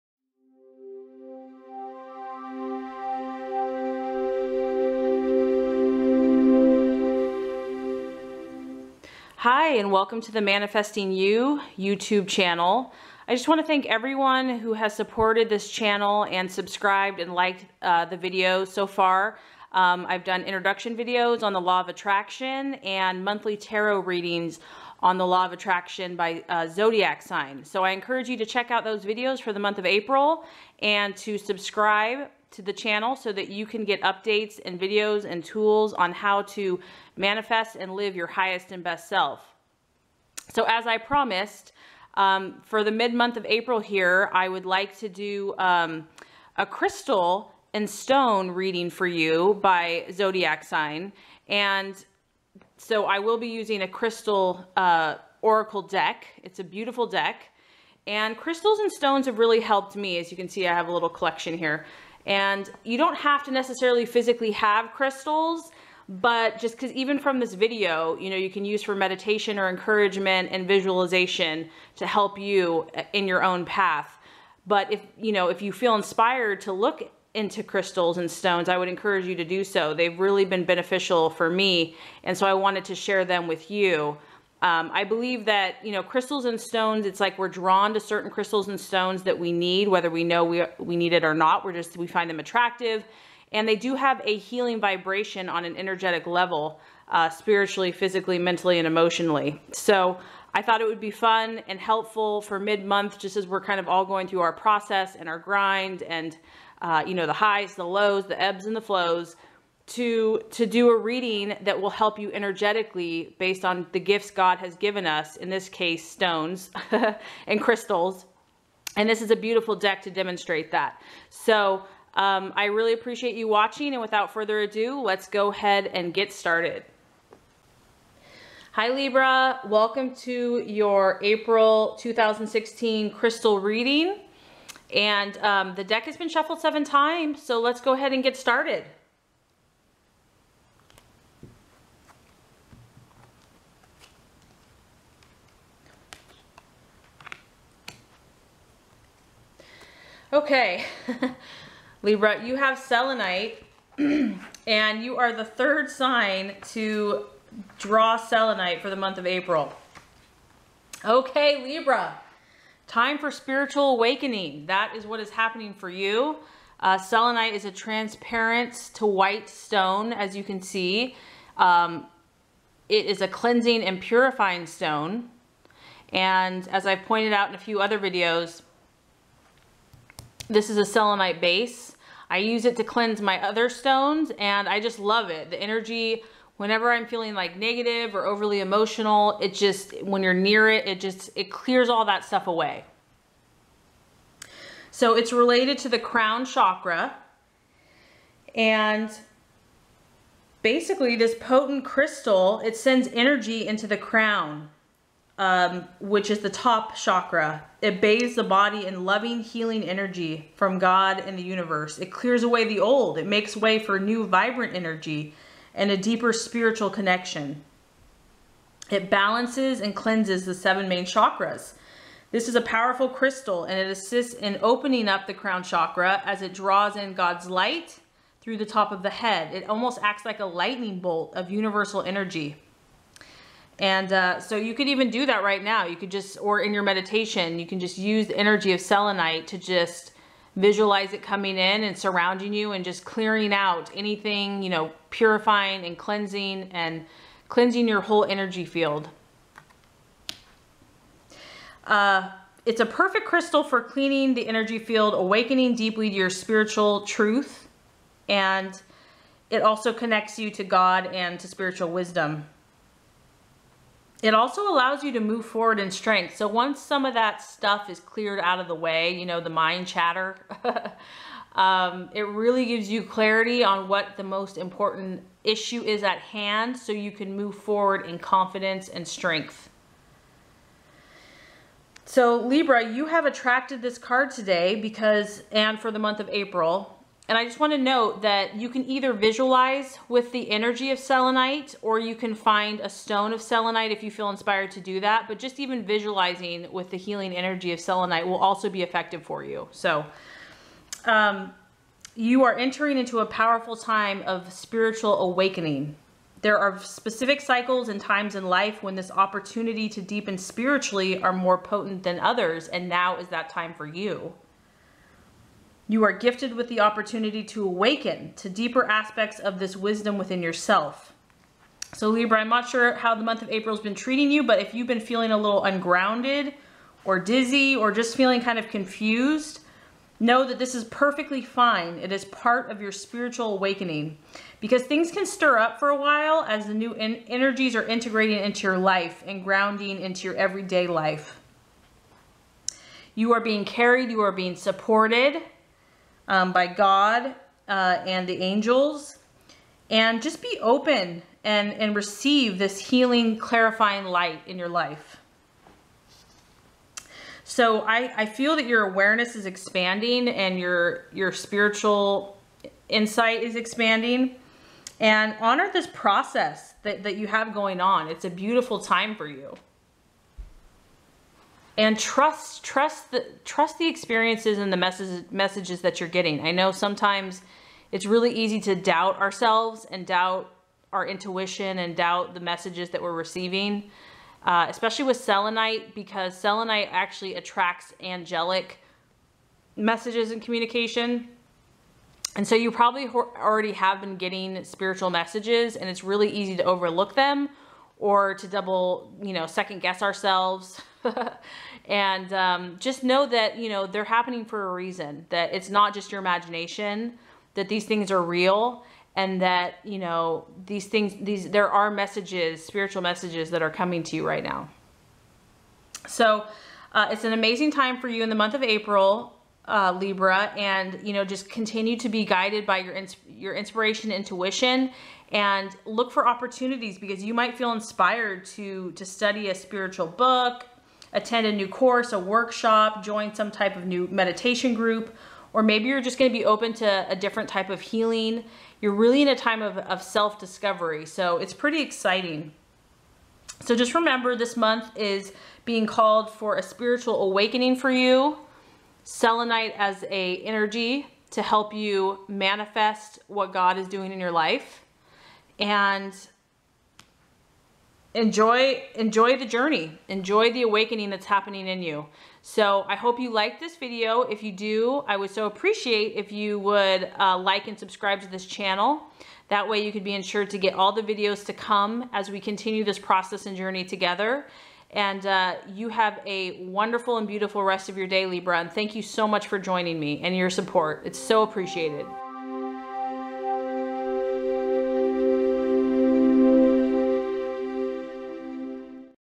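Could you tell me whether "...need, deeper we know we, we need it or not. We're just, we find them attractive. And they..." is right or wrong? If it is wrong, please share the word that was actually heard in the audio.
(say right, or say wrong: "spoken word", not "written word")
wrong: "whether", not "deeper".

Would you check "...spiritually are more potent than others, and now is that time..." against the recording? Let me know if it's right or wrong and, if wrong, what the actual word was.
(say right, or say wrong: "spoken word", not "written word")
right.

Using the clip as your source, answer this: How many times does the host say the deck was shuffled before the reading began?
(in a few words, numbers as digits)
7.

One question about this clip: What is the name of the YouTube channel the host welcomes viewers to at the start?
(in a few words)
Manifesting You.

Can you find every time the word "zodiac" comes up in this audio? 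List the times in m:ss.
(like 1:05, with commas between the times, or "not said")
0:26, 0:50.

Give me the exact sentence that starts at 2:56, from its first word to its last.
And as I've pointed out in a few other videos, this is a selenite base.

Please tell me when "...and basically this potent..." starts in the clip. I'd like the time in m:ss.
3:18.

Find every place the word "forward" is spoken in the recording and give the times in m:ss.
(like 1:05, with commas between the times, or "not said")
4:25, 4:37.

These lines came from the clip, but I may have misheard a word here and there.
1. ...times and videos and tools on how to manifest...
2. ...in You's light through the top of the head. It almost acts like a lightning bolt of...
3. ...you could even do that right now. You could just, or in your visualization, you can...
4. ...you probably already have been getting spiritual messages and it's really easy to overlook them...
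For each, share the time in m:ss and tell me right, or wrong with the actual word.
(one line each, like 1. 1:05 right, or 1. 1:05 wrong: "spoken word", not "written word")
1. 0:34 wrong: "updates", not "times"
2. 3:46 wrong: "God", not "You"
3. 3:54 wrong: "meditation", not "visualization"
4. 6:32 right.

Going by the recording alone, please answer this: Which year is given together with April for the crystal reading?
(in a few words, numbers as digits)
2016.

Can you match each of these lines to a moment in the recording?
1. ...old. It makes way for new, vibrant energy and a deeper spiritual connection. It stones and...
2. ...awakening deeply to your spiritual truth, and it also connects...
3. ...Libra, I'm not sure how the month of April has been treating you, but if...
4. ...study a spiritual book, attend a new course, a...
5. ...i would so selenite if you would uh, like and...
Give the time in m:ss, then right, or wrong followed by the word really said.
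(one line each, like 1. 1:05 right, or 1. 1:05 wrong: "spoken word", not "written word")
1. 3:32 wrong: "balances", not "stones"
2. 4:15 right
3. 5:22 right
4. 7:09 right
5. 7:45 wrong: "appreciate", not "selenite".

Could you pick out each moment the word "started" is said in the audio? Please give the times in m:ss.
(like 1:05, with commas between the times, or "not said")
2:06, 2:18.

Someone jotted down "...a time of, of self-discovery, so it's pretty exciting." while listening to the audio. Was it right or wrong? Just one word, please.
right.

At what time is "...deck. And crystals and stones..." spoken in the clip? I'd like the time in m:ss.
0:57.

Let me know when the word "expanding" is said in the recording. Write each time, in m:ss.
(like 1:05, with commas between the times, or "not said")
5:59, 6:03.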